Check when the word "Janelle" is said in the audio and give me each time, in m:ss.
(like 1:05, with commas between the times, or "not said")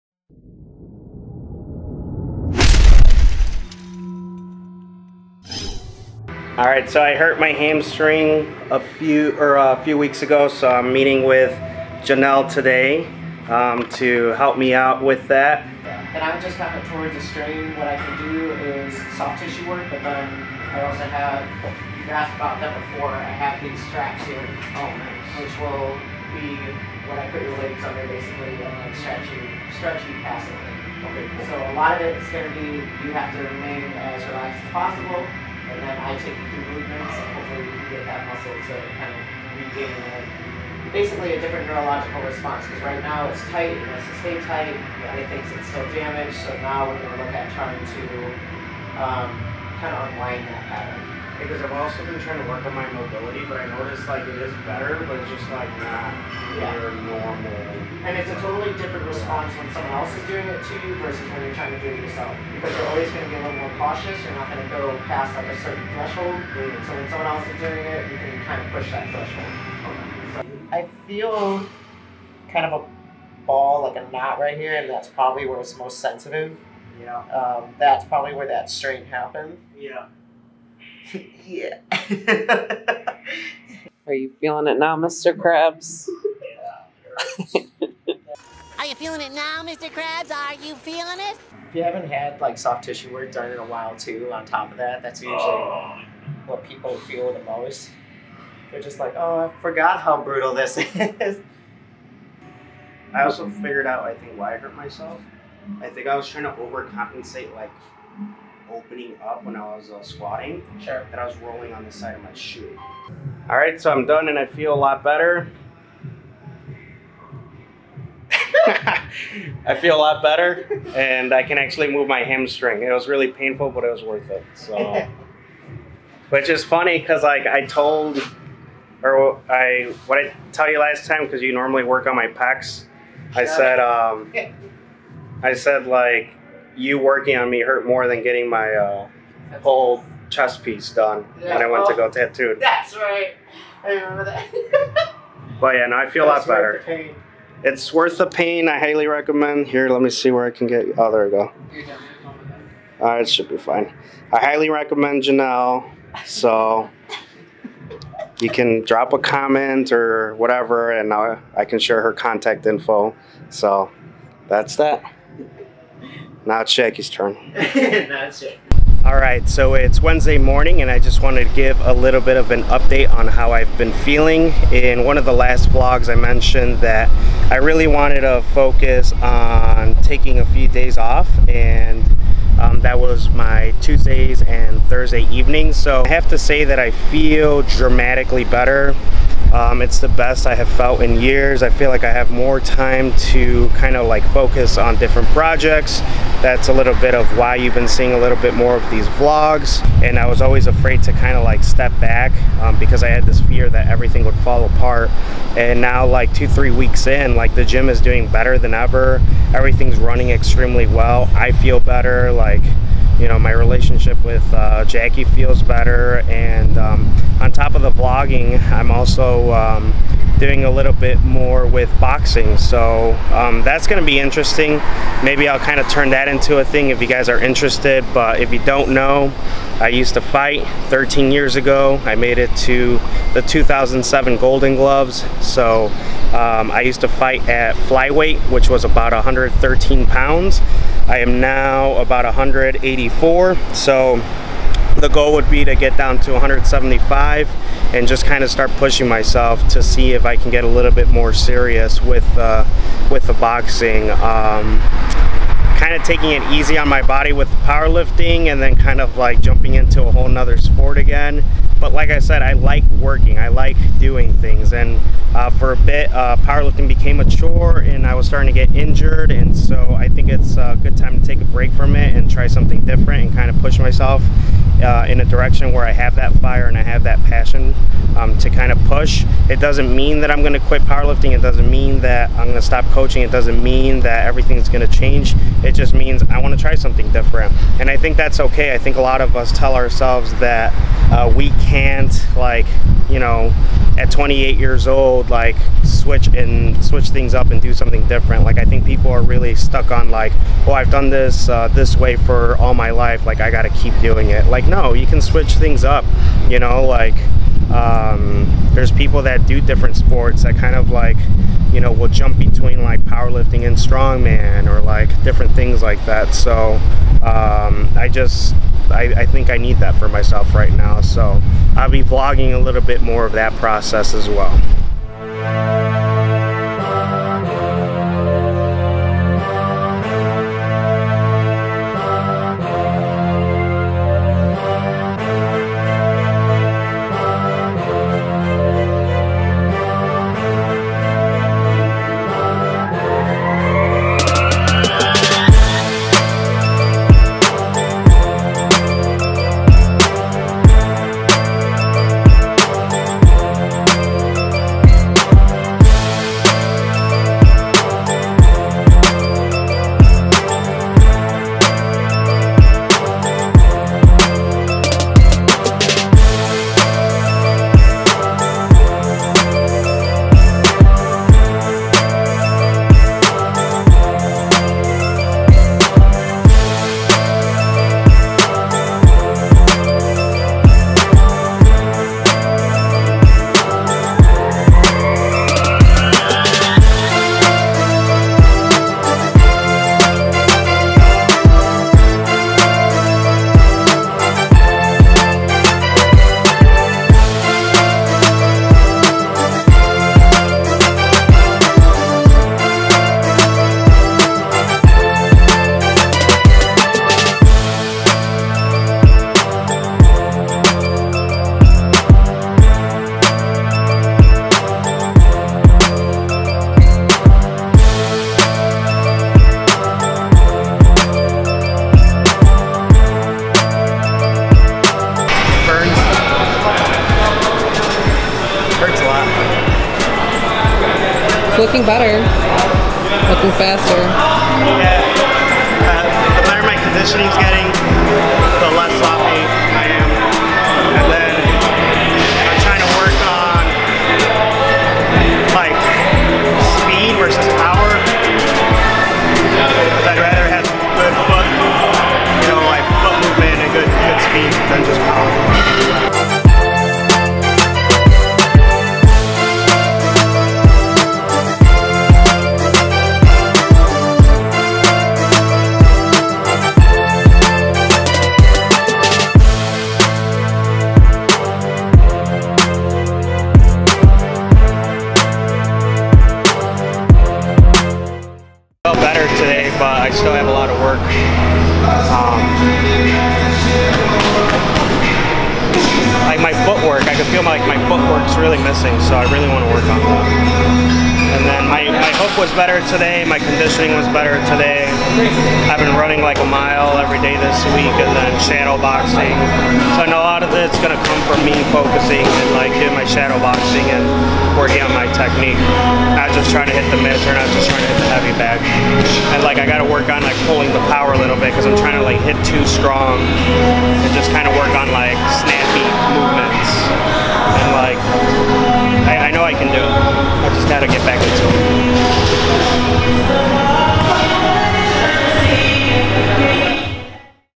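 0:12, 2:35.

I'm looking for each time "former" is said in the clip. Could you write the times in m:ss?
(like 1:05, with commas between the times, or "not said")
not said.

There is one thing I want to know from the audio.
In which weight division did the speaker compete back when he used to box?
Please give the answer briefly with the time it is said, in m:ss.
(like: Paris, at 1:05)
flyweight, at 3:57.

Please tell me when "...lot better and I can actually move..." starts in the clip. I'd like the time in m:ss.
1:59.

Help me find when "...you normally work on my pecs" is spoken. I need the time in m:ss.
2:11.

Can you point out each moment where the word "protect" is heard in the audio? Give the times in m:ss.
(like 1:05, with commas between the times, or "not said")
not said.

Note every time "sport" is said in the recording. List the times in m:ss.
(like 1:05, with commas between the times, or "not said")
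4:20, 5:09.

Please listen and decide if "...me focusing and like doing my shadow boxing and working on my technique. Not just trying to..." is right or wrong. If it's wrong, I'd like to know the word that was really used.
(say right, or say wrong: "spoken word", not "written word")
right.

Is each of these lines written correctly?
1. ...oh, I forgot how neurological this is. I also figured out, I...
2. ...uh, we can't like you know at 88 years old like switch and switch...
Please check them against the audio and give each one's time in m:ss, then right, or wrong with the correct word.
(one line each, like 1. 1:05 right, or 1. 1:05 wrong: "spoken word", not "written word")
1. 1:39 wrong: "brutal", not "neurological"
2. 4:51 wrong: "28", not "88".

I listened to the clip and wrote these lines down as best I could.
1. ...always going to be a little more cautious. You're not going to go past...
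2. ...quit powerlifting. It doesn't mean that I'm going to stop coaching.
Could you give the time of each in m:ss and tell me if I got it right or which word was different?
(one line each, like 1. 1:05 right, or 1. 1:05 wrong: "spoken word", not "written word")
1. 1:02 right
2. 4:40 right.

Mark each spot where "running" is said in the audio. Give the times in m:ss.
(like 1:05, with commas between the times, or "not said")
3:29, 8:15.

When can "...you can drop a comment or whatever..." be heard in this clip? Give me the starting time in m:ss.
2:38.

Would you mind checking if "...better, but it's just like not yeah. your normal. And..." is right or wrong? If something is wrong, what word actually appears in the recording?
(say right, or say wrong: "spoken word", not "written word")
right.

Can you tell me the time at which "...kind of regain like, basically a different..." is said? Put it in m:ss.
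0:38.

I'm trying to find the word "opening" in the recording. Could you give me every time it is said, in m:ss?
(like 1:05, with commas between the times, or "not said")
1:48.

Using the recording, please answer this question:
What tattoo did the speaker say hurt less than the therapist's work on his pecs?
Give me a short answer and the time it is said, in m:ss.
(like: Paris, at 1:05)
whole chest piece, at 2:19.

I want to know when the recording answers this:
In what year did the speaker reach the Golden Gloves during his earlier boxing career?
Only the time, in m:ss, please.
3:53.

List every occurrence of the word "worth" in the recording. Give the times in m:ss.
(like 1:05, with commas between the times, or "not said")
2:04, 2:27.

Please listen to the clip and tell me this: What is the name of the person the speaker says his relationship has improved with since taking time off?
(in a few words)
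Jackie.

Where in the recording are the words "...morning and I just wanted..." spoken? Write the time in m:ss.
2:50.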